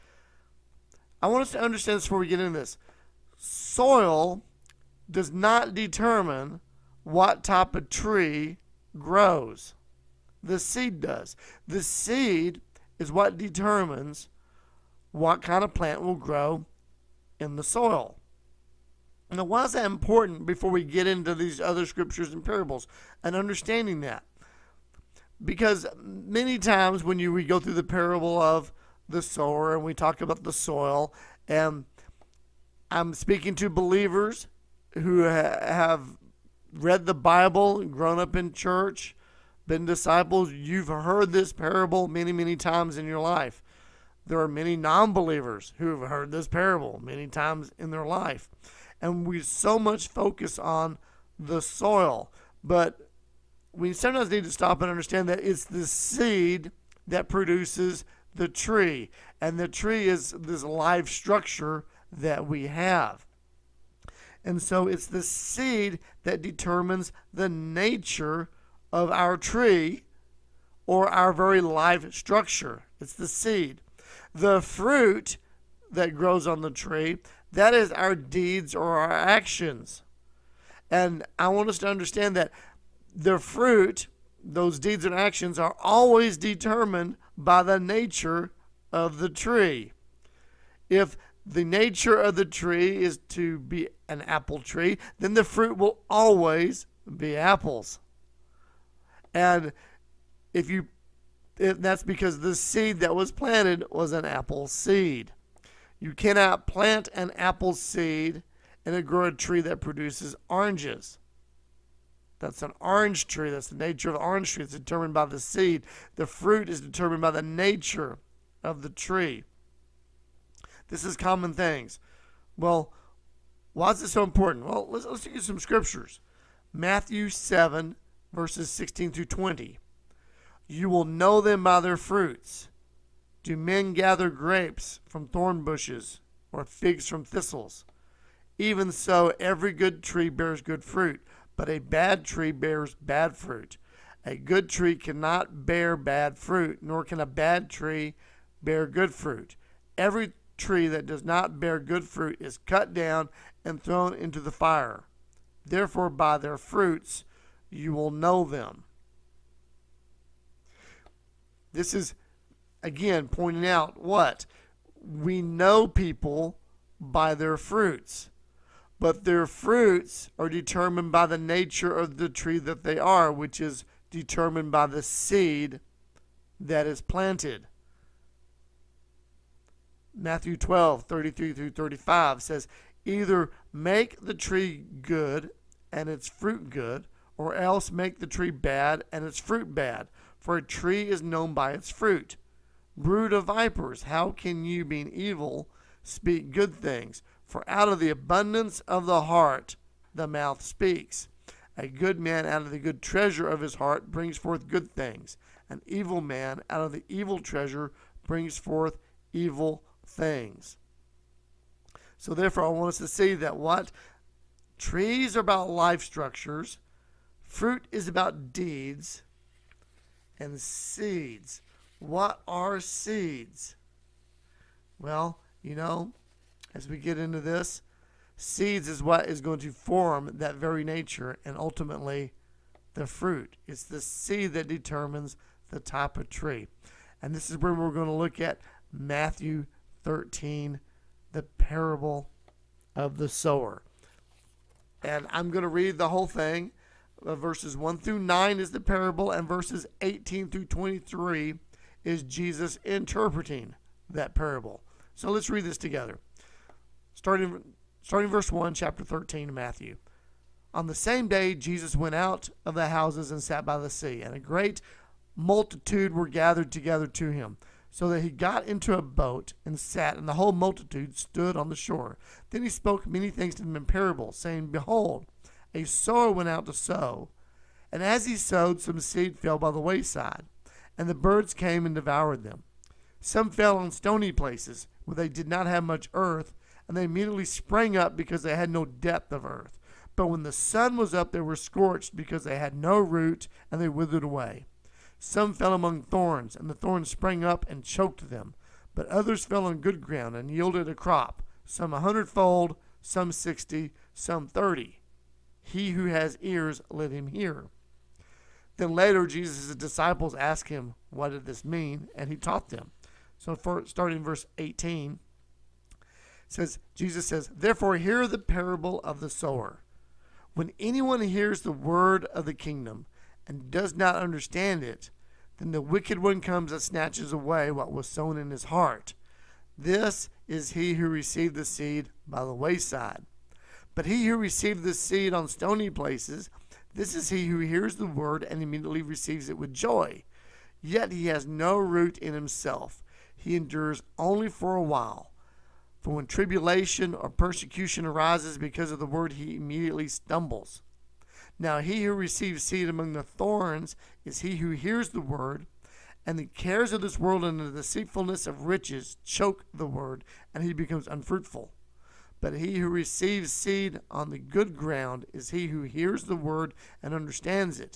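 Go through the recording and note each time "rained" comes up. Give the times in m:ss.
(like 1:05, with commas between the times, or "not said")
not said.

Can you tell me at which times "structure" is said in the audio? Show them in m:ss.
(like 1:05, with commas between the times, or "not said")
1:01, 1:12, 3:36.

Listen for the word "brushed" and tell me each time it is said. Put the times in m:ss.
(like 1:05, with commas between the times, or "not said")
not said.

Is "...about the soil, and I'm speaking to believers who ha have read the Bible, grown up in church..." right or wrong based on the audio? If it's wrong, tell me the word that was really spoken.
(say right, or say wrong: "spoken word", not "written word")
right.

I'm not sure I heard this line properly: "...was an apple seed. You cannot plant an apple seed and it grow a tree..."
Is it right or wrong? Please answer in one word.
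right.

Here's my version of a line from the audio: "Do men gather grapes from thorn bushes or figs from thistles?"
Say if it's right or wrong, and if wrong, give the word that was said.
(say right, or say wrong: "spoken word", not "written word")
right.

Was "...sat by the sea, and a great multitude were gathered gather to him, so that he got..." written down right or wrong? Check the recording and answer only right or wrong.
wrong.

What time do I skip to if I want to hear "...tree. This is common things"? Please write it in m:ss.
1:58.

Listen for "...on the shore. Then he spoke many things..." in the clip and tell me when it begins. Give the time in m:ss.
4:31.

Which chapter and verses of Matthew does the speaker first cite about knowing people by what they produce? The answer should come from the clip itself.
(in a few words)
Matthew 7:16-20.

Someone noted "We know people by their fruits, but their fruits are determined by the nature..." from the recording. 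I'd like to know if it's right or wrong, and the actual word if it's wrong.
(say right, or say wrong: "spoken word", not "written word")
right.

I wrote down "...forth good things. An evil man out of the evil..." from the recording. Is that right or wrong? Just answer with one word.
right.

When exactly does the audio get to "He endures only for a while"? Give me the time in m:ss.
5:43.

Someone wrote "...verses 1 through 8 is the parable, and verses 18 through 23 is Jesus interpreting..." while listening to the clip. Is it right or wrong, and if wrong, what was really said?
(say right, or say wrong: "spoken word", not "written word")
wrong: "9", not "8".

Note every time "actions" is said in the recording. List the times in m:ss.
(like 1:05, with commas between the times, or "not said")
1:19, 1:25.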